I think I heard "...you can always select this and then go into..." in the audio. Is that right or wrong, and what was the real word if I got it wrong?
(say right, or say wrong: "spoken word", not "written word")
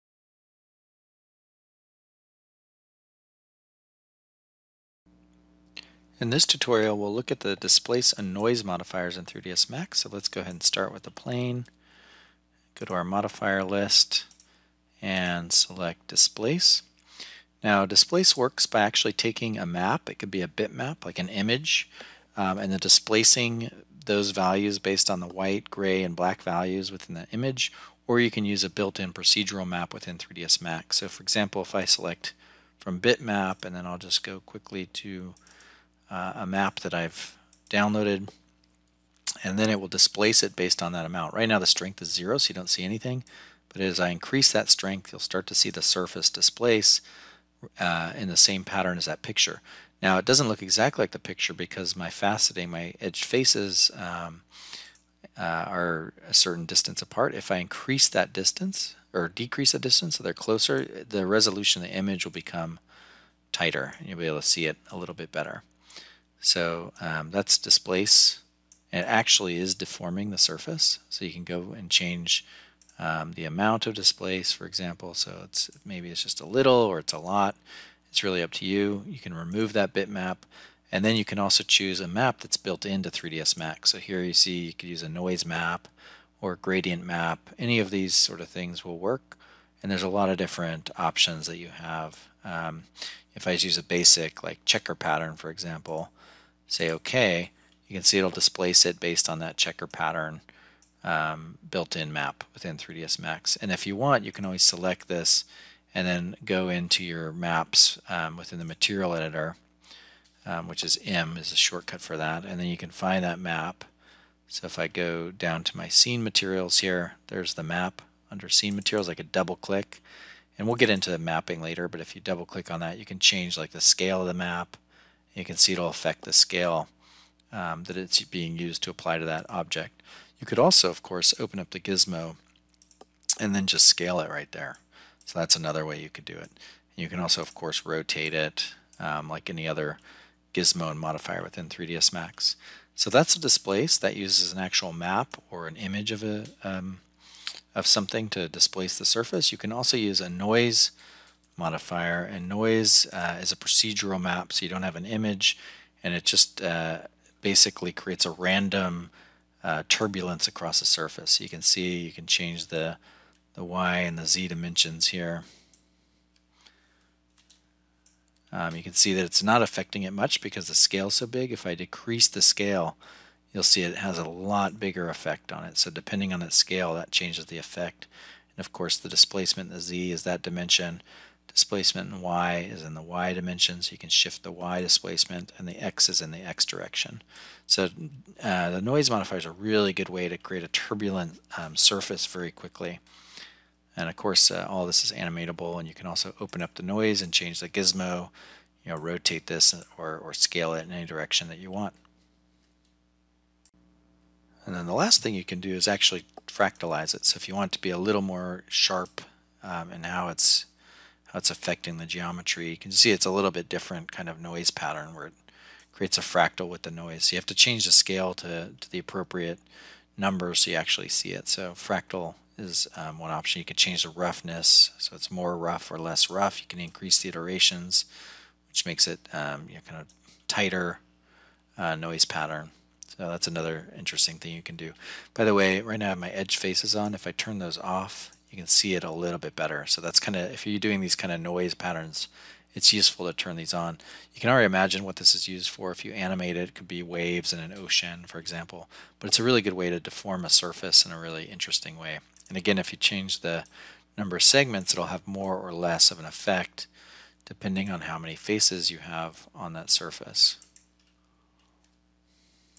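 right.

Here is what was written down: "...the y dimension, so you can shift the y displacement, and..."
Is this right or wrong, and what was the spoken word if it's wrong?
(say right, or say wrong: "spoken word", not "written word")
right.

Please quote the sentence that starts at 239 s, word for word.
So that's kind of, if you're doing these kind of noise patterns, it's useful to turn these on.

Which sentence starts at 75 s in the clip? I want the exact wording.
So it's maybe it's just a little or it's a lot.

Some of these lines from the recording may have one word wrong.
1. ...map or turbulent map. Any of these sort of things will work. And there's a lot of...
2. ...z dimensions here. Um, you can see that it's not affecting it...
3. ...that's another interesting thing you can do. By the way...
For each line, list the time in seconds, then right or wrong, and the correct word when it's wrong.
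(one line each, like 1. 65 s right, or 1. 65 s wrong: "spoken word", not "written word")
1. 85 s wrong: "gradient", not "turbulent"
2. 164 s right
3. 233 s right.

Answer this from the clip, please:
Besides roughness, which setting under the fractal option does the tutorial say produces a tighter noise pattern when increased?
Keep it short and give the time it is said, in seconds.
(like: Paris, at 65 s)
Iterations, at 227 s.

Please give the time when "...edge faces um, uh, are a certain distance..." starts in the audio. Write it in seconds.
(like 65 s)
52 s.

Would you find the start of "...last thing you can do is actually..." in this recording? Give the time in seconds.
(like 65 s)
204 s.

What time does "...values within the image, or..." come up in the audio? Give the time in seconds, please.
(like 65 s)
26 s.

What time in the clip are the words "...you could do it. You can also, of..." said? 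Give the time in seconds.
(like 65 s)
136 s.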